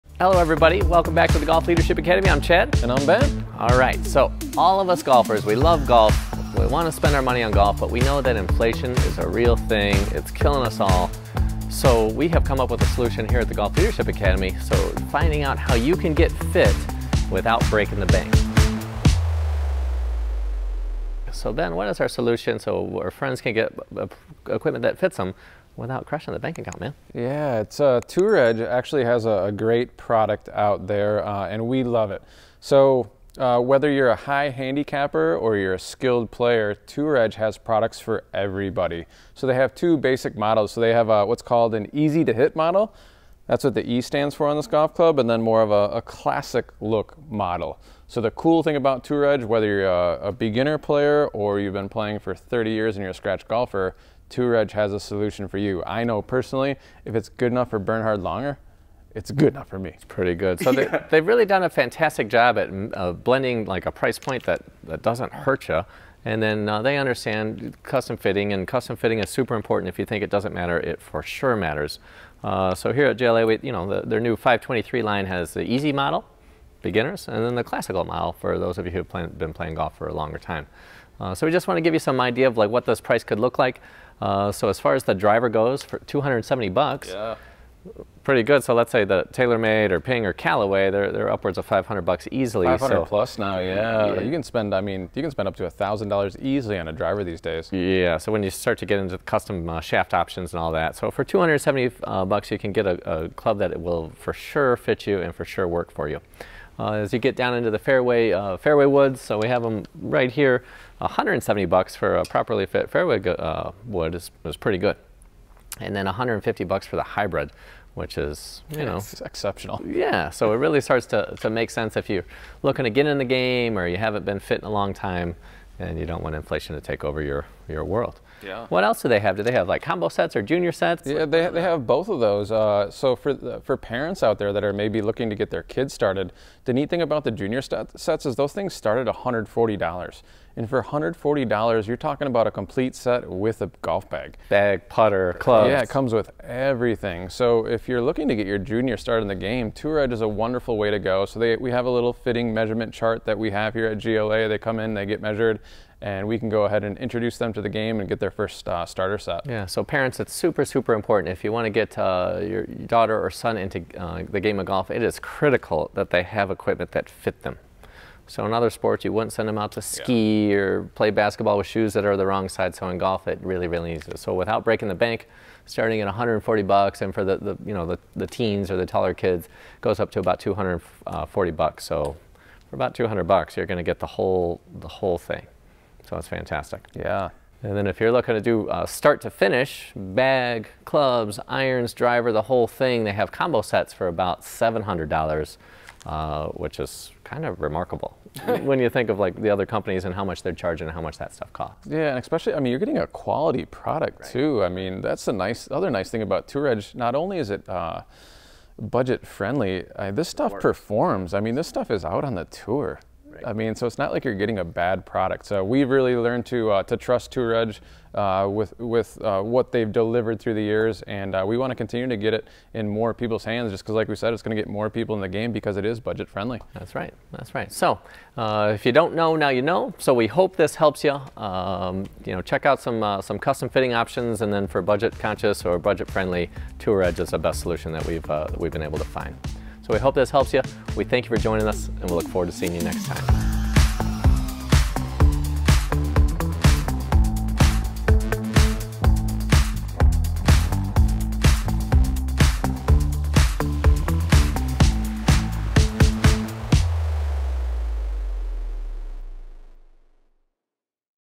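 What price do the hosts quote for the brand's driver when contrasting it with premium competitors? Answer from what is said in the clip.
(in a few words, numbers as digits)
$270.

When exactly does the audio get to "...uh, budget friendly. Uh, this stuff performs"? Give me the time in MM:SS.
03:27.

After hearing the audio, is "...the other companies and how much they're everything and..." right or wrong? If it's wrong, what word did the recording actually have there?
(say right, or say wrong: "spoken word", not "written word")
wrong: "charging", not "everything".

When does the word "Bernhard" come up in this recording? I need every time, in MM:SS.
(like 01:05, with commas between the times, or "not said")
00:57.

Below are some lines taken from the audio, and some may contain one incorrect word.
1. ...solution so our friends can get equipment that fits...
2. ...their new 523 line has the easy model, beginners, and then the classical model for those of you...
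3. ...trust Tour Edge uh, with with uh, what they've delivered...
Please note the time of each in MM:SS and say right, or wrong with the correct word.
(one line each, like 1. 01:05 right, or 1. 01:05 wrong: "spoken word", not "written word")
1. 00:22 right
2. 01:14 right
3. 03:36 right.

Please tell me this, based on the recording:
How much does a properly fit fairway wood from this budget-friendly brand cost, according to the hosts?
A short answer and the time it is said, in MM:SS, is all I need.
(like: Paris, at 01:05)
$170, at 01:50.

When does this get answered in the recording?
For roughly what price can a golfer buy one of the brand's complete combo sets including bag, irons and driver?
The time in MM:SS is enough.
03:14.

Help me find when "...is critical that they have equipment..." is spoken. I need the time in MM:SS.
02:45.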